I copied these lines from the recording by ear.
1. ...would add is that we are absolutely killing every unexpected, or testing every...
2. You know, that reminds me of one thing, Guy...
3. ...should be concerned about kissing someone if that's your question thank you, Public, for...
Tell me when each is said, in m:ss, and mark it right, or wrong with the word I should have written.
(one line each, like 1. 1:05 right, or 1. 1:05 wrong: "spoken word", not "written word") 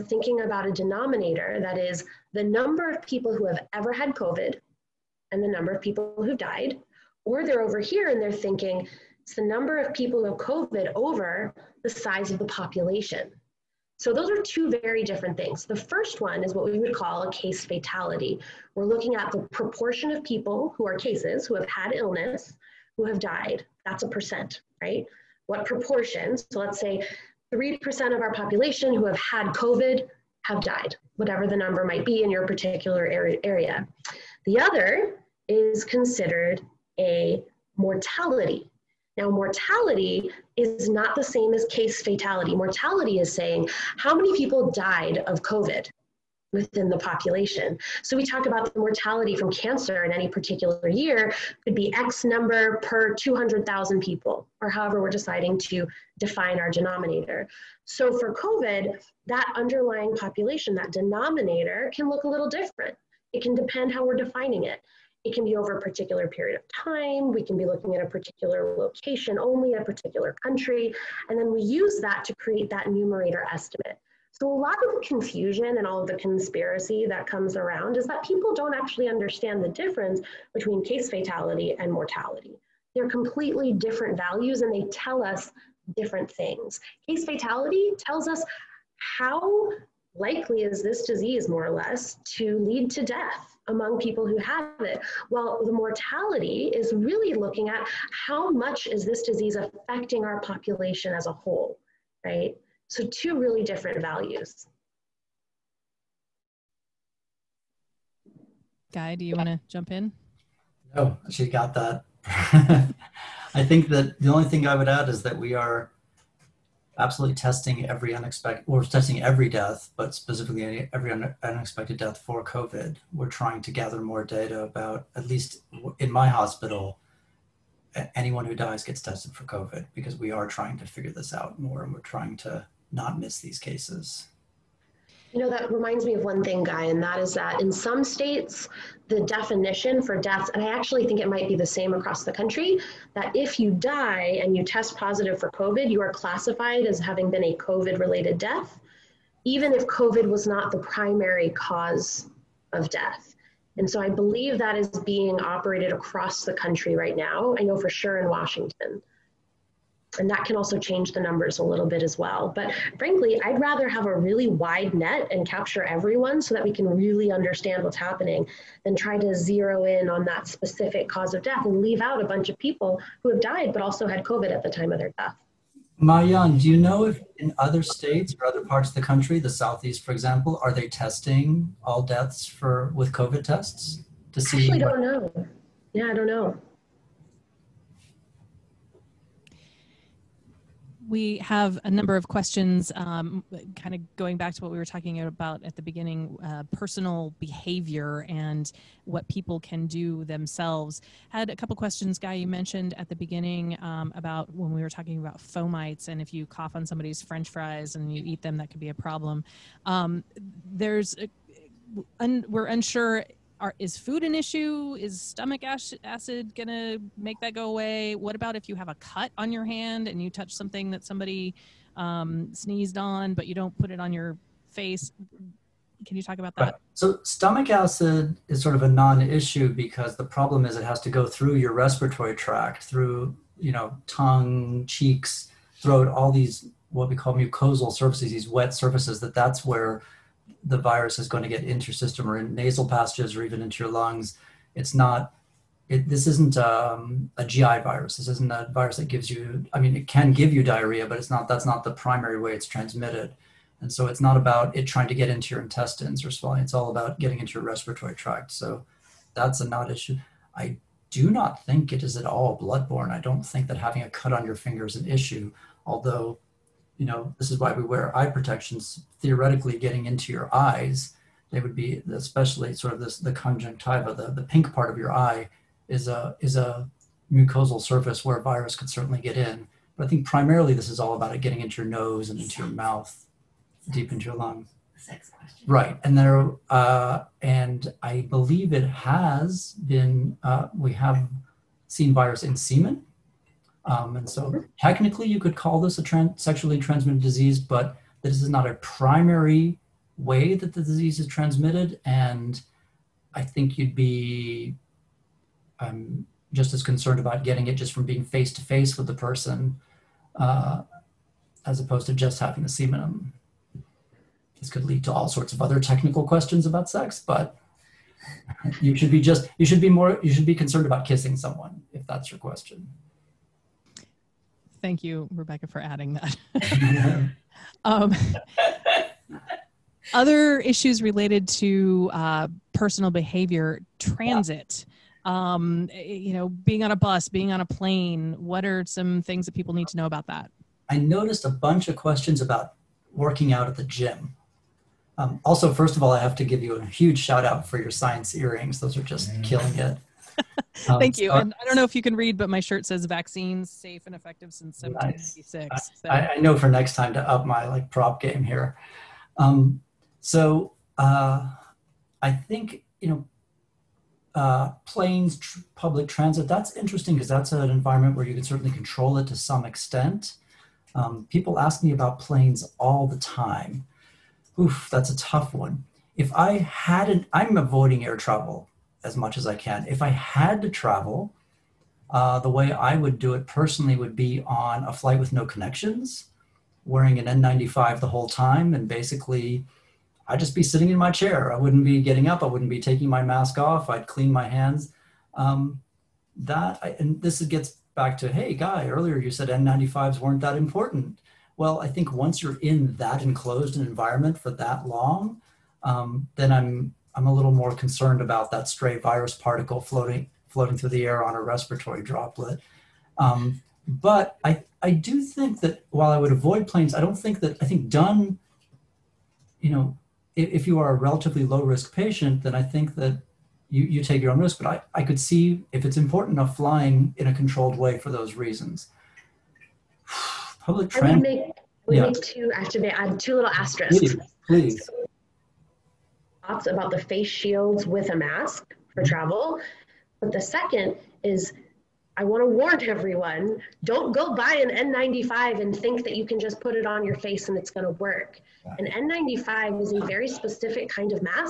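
1. 1:54 wrong: "testing", not "killing"
2. 2:15 right
3. 5:20 wrong: "Rebecca", not "Public".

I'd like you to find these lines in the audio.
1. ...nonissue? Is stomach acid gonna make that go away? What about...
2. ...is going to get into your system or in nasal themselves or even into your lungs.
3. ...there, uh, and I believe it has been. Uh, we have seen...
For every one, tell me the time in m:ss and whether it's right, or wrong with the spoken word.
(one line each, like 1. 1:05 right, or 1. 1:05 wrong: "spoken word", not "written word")
1. 3:34 wrong: "issue", not "nonissue"
2. 4:01 wrong: "passages", not "themselves"
3. 4:46 right.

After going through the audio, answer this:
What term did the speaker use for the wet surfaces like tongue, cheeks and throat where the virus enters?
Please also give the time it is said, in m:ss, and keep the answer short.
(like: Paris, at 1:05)
mucosal surfaces, at 3:57.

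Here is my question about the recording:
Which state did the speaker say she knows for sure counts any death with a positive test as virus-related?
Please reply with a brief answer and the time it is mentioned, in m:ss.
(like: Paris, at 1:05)
Washington, at 2:38.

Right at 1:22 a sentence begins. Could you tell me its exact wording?
They're completely different values and they tell us different things.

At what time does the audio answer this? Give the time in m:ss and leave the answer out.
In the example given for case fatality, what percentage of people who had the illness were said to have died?
0:27.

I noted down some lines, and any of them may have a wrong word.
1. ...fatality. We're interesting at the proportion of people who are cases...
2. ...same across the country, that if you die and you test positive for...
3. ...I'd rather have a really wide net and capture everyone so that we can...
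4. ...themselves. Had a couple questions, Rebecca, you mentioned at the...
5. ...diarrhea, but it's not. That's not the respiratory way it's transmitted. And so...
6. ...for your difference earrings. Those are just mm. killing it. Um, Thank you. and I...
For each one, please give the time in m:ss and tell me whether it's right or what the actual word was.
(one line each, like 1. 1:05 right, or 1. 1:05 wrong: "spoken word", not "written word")
1. 0:17 wrong: "looking", not "interesting"
2. 2:21 right
3. 2:43 right
4. 3:20 wrong: "Guy", not "Rebecca"
5. 4:10 wrong: "primary", not "respiratory"
6. 5:47 wrong: "science", not "difference".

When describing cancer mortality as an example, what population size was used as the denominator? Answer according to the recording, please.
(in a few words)
200,000.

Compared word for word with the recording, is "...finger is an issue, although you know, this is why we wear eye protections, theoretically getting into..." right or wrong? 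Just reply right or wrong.
right.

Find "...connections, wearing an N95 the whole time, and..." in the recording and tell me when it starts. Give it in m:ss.
6:25.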